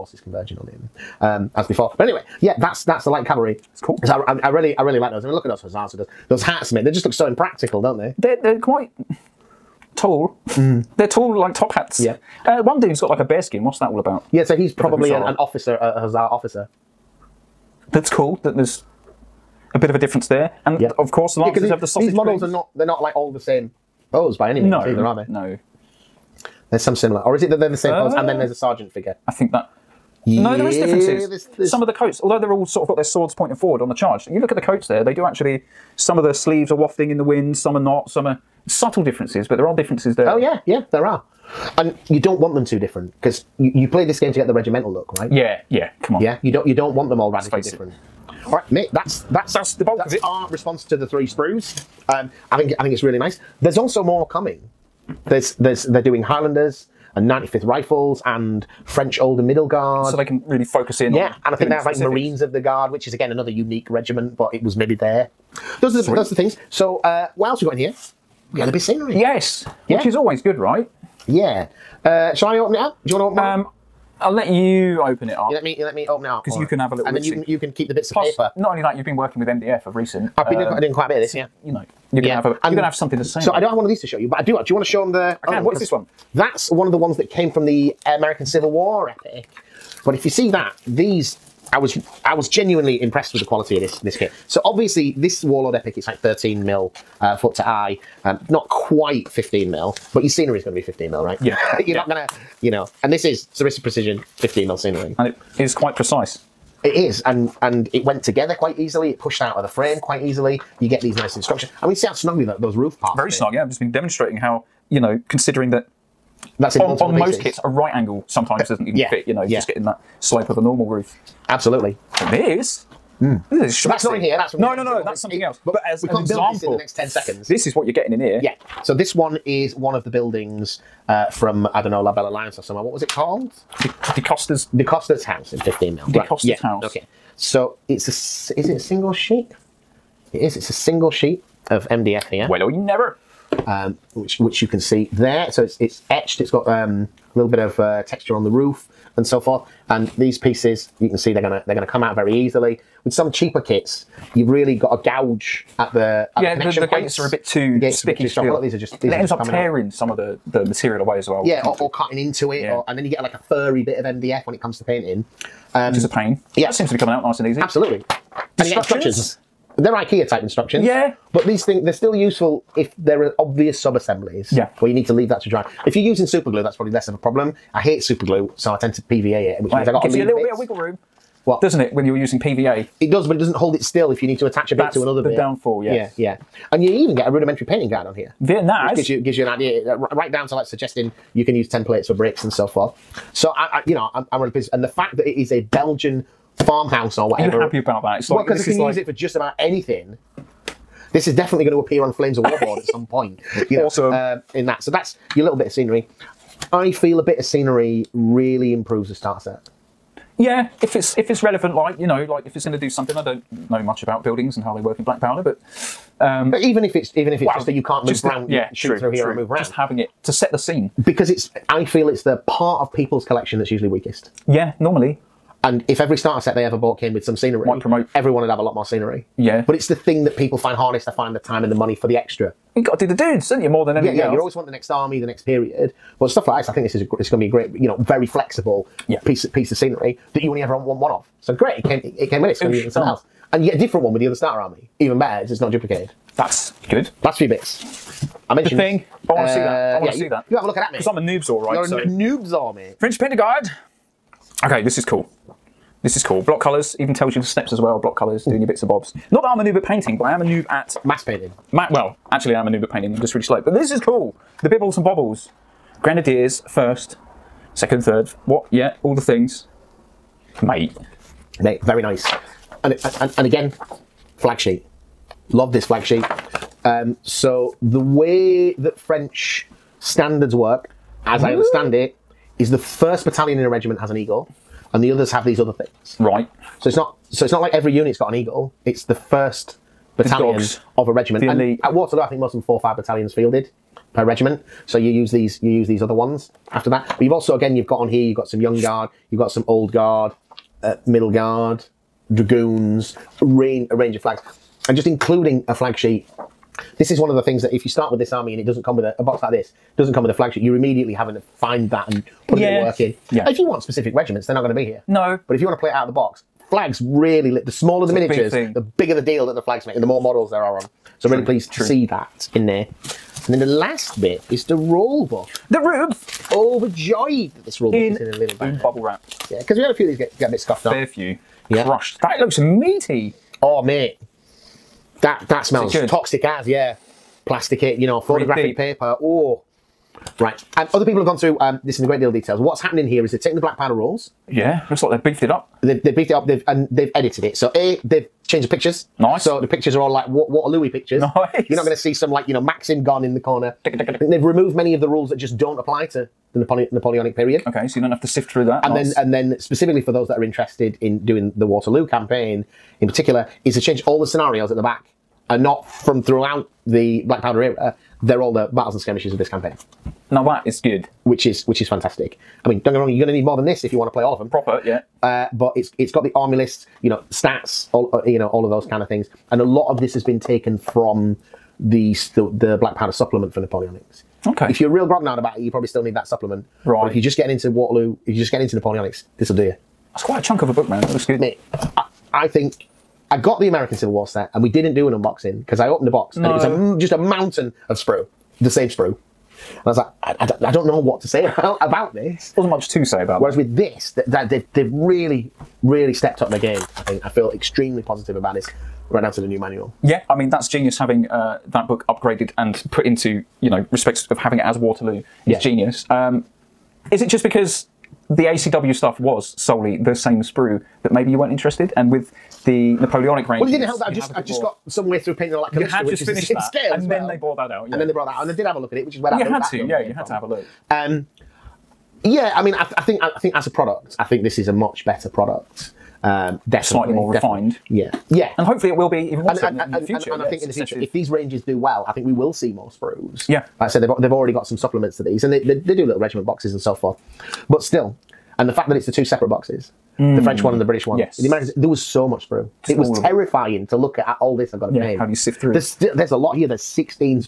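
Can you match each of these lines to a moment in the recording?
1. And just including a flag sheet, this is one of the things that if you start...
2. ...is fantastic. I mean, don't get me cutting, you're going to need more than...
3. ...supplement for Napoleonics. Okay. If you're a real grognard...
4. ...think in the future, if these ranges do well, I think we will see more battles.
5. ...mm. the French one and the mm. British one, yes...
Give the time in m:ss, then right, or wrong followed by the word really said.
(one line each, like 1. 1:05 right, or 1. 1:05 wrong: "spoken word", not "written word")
1. 5:04 right
2. 6:11 wrong: "wrong", not "cutting"
3. 6:23 right
4. 7:20 wrong: "sprues", not "battles"
5. 7:30 right.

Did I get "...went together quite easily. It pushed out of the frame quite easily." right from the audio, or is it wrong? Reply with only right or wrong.
right.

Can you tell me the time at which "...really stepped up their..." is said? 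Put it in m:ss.
6:45.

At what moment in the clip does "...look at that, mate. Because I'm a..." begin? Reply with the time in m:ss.
4:10.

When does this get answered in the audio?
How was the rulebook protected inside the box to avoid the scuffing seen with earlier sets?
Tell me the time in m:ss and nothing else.
5:28.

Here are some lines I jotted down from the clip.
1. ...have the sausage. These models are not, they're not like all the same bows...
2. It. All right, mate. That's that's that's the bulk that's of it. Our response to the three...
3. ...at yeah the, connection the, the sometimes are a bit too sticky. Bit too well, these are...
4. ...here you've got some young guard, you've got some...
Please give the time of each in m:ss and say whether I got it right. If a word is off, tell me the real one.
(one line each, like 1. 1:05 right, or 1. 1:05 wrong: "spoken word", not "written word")
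1. 0:21 right
2. 0:47 right
3. 2:36 wrong: "gates", not "sometimes"
4. 4:58 right.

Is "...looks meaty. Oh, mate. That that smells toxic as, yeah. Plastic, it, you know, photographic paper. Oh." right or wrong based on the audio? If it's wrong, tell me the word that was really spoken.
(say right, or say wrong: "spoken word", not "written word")
right.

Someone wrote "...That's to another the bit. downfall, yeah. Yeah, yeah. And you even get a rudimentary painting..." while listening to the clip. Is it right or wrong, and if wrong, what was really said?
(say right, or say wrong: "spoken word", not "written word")
right.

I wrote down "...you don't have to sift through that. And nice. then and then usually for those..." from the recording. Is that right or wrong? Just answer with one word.
wrong.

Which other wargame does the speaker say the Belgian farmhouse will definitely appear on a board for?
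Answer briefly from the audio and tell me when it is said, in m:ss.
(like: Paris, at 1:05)
Flames of War, at 3:22.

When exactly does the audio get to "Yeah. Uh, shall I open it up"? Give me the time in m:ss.
1:11.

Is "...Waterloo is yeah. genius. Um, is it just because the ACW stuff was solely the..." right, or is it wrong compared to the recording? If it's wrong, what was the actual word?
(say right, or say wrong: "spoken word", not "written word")
right.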